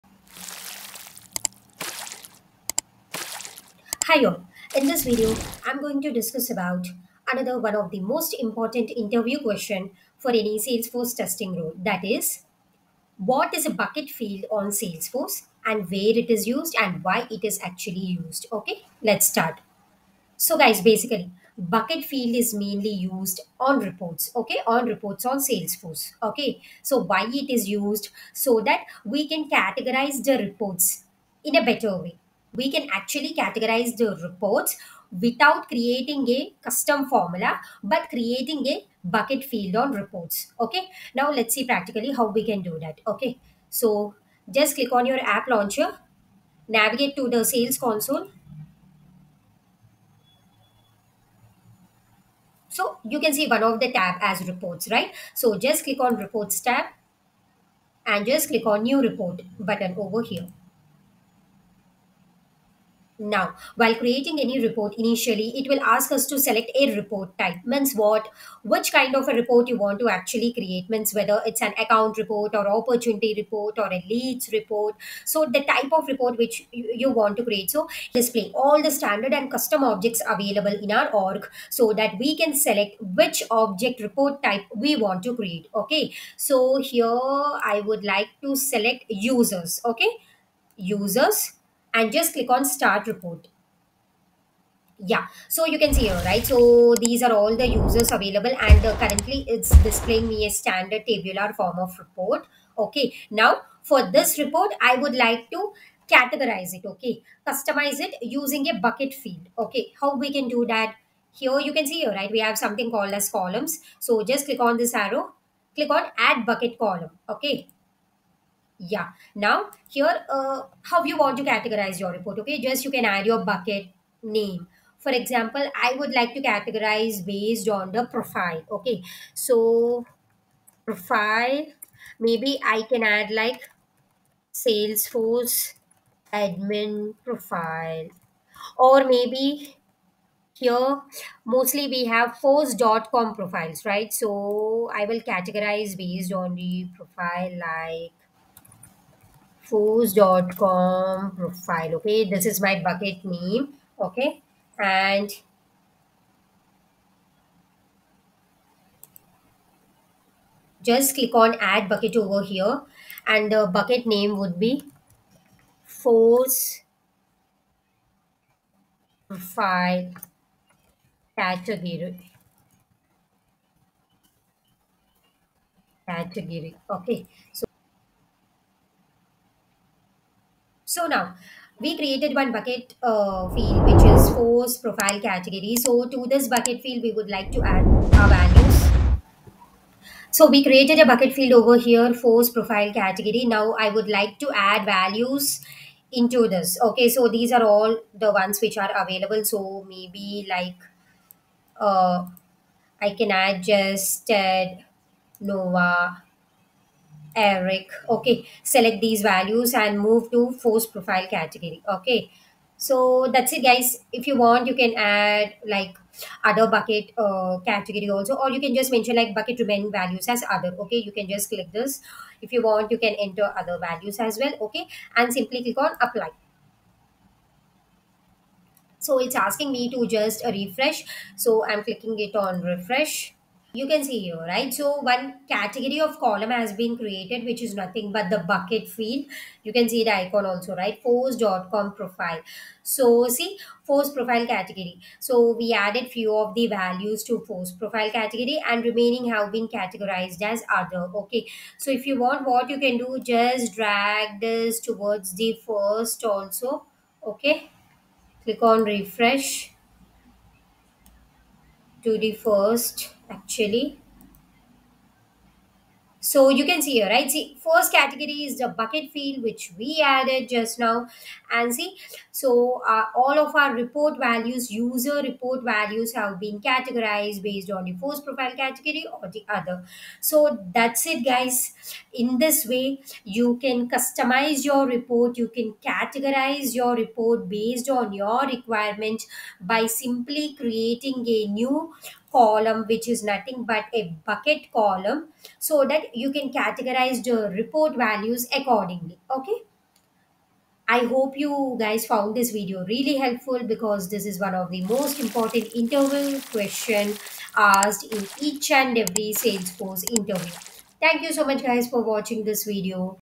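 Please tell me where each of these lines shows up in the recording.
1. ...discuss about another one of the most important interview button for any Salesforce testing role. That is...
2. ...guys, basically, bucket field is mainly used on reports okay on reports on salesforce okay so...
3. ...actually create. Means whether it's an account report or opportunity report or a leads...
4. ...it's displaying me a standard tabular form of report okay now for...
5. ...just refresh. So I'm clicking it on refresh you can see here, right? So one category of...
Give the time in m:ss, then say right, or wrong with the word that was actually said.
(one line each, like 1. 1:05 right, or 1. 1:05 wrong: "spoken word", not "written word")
1. 0:06 wrong: "question", not "button"
2. 0:20 right
3. 1:10 right
4. 1:39 right
5. 3:50 right.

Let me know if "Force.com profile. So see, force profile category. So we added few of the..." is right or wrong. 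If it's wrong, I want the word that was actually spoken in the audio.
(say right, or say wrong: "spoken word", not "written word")
right.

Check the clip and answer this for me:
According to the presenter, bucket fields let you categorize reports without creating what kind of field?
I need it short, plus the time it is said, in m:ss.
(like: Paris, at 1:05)
Custom formula, at 0:36.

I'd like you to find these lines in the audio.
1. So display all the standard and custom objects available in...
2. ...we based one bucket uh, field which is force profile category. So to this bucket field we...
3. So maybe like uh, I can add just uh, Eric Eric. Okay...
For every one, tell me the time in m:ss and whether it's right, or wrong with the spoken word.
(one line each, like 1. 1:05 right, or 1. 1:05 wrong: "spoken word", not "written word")
1. 1:17 right
2. 3:01 wrong: "created", not "based"
3. 3:19 wrong: "Nova", not "Eric".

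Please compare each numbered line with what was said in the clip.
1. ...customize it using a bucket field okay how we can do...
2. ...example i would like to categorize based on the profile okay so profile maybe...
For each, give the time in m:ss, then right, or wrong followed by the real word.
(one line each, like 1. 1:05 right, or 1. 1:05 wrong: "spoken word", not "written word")
1. 1:47 right
2. 2:05 right.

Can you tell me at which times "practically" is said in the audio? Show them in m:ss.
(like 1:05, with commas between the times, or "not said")
0:41.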